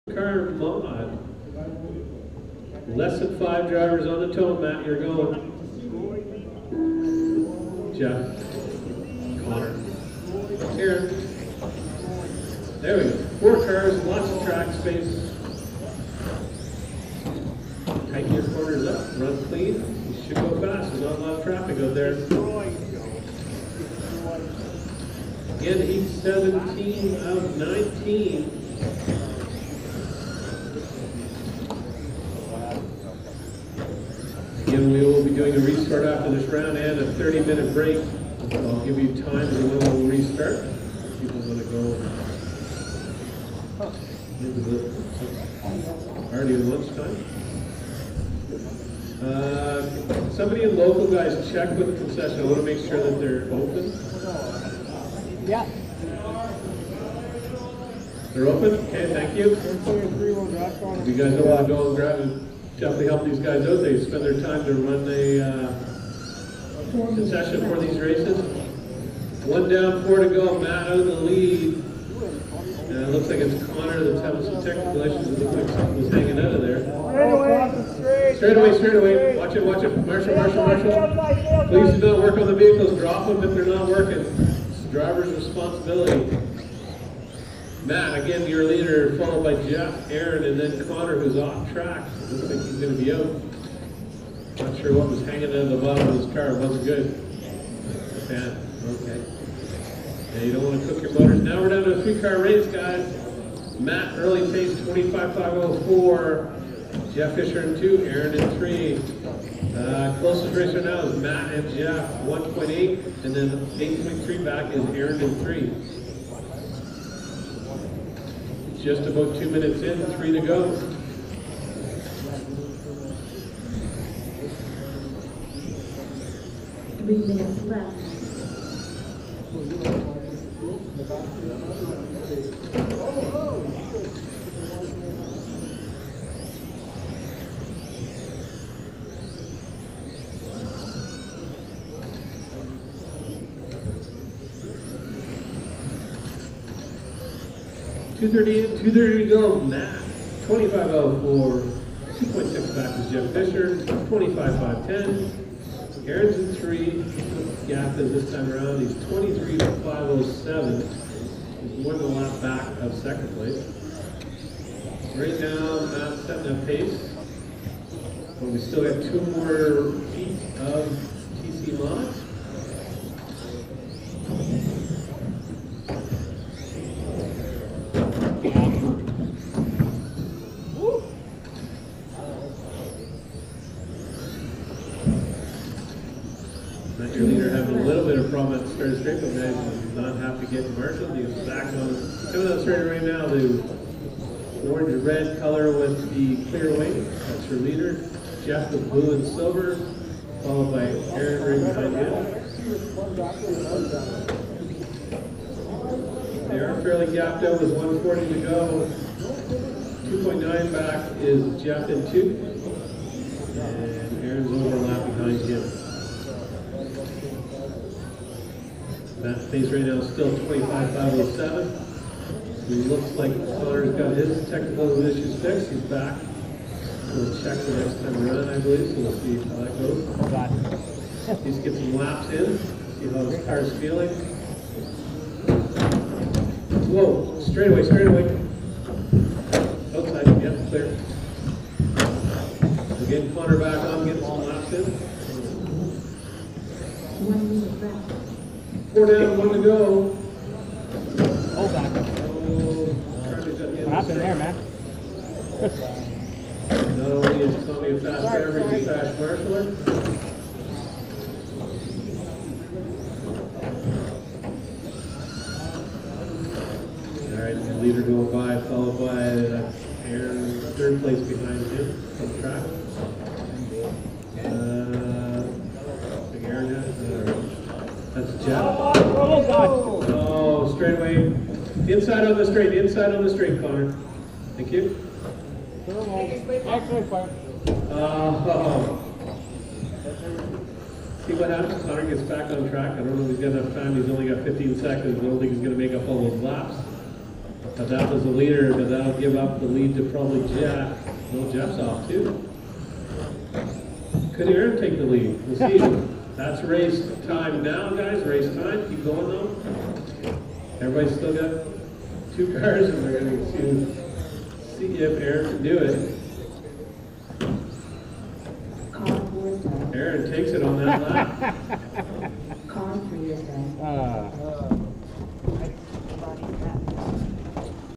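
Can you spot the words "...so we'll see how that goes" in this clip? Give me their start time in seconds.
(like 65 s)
228 s.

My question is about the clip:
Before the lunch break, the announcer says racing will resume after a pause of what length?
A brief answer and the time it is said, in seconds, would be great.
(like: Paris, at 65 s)
30 minutes, at 37 s.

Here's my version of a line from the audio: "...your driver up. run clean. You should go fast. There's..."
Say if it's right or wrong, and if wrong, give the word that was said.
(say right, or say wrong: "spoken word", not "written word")
wrong: "corner", not "driver".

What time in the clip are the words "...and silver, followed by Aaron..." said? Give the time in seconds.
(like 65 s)
199 s.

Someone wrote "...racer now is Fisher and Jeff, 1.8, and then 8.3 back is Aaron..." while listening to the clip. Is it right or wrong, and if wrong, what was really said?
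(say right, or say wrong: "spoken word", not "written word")
wrong: "Matt", not "Fisher".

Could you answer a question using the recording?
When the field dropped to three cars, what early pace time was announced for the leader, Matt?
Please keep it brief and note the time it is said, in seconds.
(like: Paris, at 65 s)
25.504, at 104 s.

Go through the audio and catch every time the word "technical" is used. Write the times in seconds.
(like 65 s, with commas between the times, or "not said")
74 s, 224 s.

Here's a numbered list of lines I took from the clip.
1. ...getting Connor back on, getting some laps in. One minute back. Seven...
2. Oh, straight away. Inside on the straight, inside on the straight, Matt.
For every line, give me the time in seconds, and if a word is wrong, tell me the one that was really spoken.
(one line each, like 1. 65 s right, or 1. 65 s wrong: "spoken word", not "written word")
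1. 243 s wrong: "Four", not "Seven"
2. 278 s wrong: "Connor", not "Matt".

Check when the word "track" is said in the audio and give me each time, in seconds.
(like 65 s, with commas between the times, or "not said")
14 s, 91 s, 272 s, 292 s.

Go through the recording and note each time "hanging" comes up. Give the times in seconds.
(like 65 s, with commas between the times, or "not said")
76 s, 95 s.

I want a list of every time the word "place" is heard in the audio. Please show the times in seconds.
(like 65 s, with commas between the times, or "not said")
163 s, 271 s.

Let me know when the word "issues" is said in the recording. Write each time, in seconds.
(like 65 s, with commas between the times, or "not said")
74 s, 225 s.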